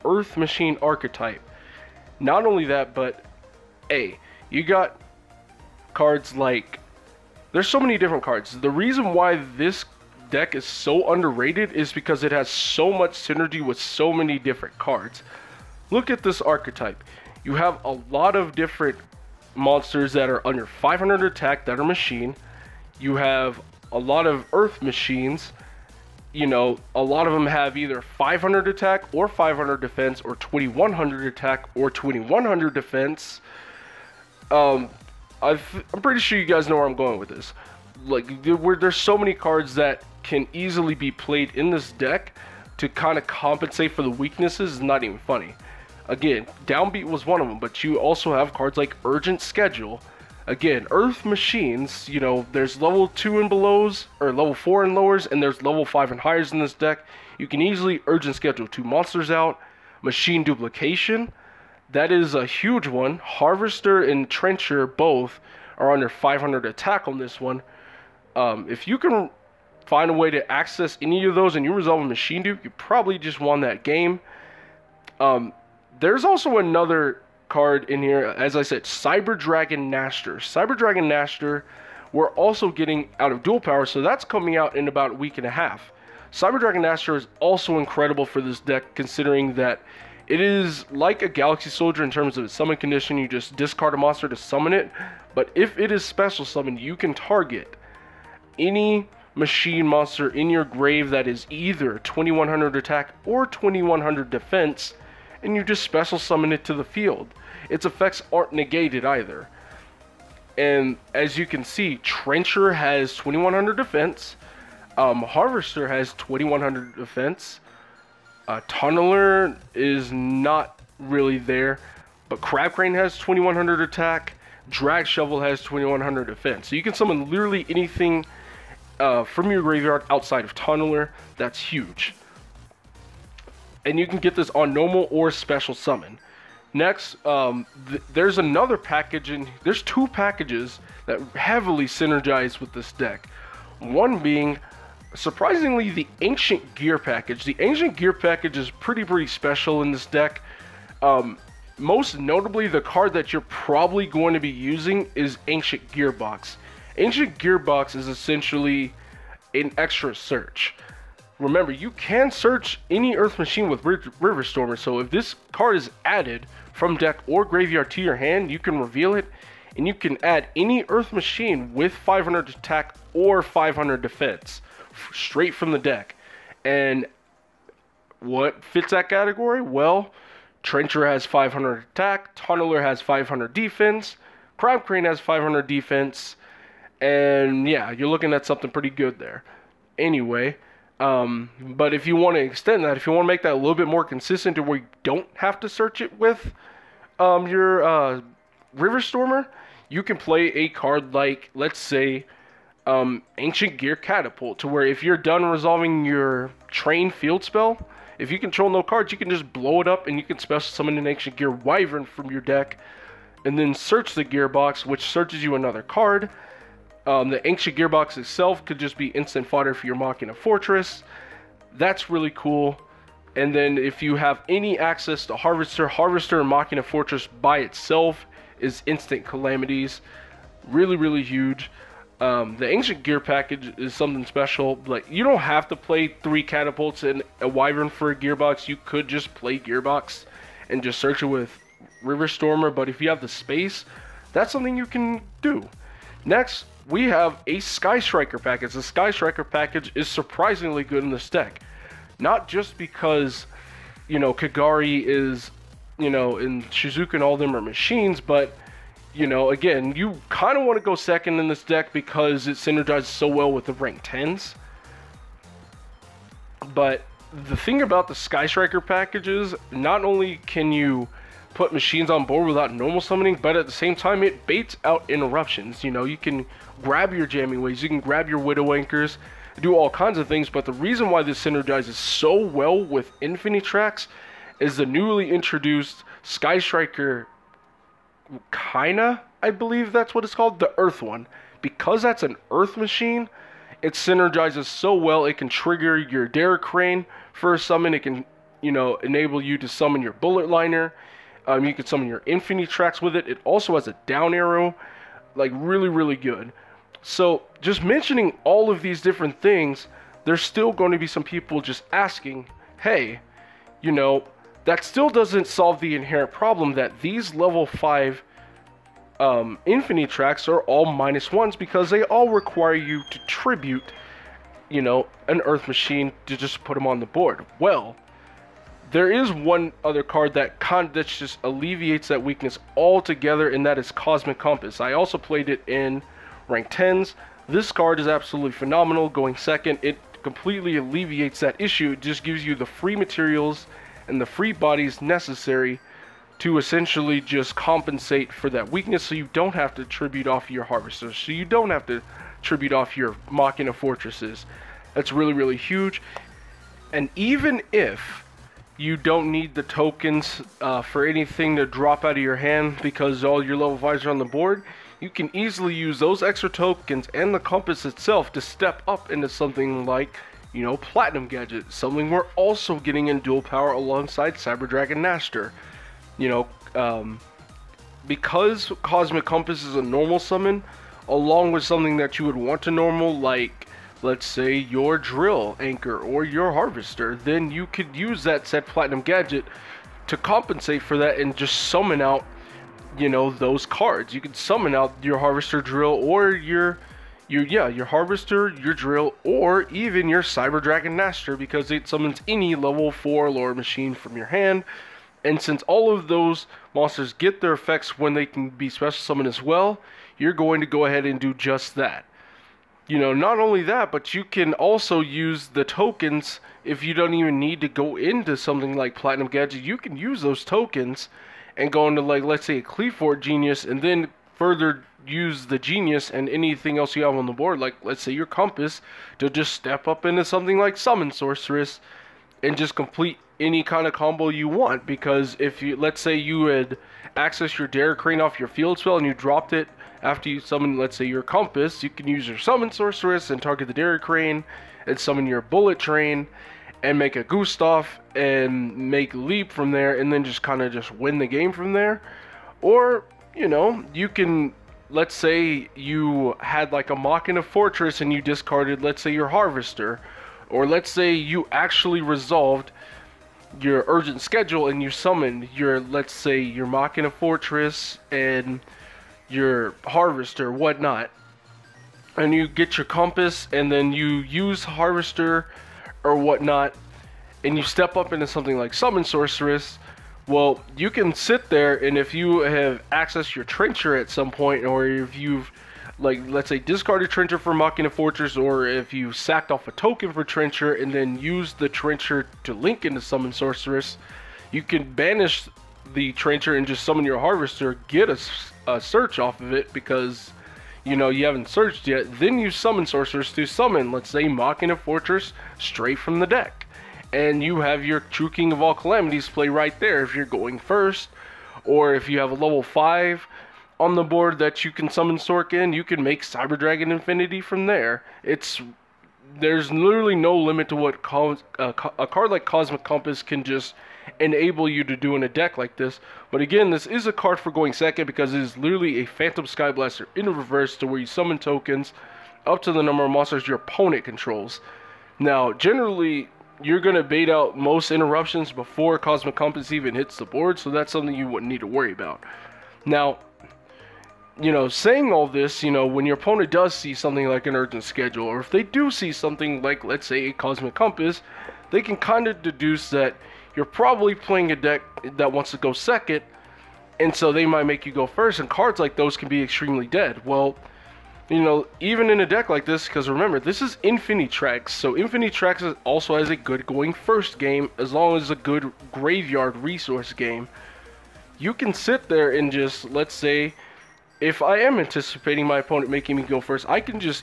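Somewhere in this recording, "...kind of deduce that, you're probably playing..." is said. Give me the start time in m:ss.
9:11.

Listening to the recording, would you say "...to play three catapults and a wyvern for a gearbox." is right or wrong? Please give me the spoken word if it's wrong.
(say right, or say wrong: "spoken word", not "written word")
right.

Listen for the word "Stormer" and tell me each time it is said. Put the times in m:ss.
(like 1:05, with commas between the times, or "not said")
2:44, 3:18, 4:02.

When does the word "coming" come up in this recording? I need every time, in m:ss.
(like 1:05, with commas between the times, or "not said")
1:24.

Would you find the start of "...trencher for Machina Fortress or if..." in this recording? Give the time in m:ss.
8:07.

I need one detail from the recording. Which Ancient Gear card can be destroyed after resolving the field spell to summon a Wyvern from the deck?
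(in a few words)
Ancient Gear Catapult.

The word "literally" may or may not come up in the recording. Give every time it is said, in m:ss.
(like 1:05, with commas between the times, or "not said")
2:07, 8:39, 8:48.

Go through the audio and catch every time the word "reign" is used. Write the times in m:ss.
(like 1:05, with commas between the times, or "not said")
not said.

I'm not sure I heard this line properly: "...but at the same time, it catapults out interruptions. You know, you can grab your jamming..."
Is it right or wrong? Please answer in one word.
wrong.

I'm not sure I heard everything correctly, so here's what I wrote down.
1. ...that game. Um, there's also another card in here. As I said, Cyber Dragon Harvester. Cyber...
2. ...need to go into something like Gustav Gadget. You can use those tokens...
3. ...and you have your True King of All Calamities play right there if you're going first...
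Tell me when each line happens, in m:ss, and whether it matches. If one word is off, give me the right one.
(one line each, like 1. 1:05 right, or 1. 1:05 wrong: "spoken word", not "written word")
1. 1:13 wrong: "Nachster", not "Harvester"
2. 6:57 wrong: "Platinum", not "Gustav"
3. 8:27 right.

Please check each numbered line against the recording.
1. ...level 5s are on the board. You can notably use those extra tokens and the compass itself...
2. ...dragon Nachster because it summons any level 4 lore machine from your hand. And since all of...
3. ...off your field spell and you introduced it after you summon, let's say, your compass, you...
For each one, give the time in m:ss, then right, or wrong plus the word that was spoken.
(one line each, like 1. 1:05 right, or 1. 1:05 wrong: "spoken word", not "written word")
1. 6:03 wrong: "easily", not "notably"
2. 6:40 right
3. 7:18 wrong: "dropped", not "introduced".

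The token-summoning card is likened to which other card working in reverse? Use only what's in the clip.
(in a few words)
Phantom Skyblaster.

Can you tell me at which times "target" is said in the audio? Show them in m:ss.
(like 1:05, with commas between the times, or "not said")
1:37, 7:23.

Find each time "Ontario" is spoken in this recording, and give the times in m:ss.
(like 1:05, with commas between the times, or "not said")
not said.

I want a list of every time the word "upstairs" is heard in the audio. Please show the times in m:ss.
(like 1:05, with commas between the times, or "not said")
not said.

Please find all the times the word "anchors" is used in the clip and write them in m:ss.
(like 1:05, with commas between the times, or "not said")
4:38, 6:25.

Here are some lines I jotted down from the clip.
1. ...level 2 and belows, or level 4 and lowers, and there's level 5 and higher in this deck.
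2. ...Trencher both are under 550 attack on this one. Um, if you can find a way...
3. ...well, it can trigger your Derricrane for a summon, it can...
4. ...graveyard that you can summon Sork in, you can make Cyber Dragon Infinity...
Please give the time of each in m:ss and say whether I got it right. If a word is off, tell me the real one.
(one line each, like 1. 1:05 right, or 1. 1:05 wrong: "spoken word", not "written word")
1. 0:52 right
2. 1:04 wrong: "500", not "550"
3. 4:54 right
4. 8:34 wrong: "board", not "graveyard".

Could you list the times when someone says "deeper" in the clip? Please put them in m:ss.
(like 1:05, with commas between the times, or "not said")
not said.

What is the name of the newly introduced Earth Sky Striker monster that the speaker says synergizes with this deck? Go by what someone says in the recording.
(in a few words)
Sky Striker Kaina.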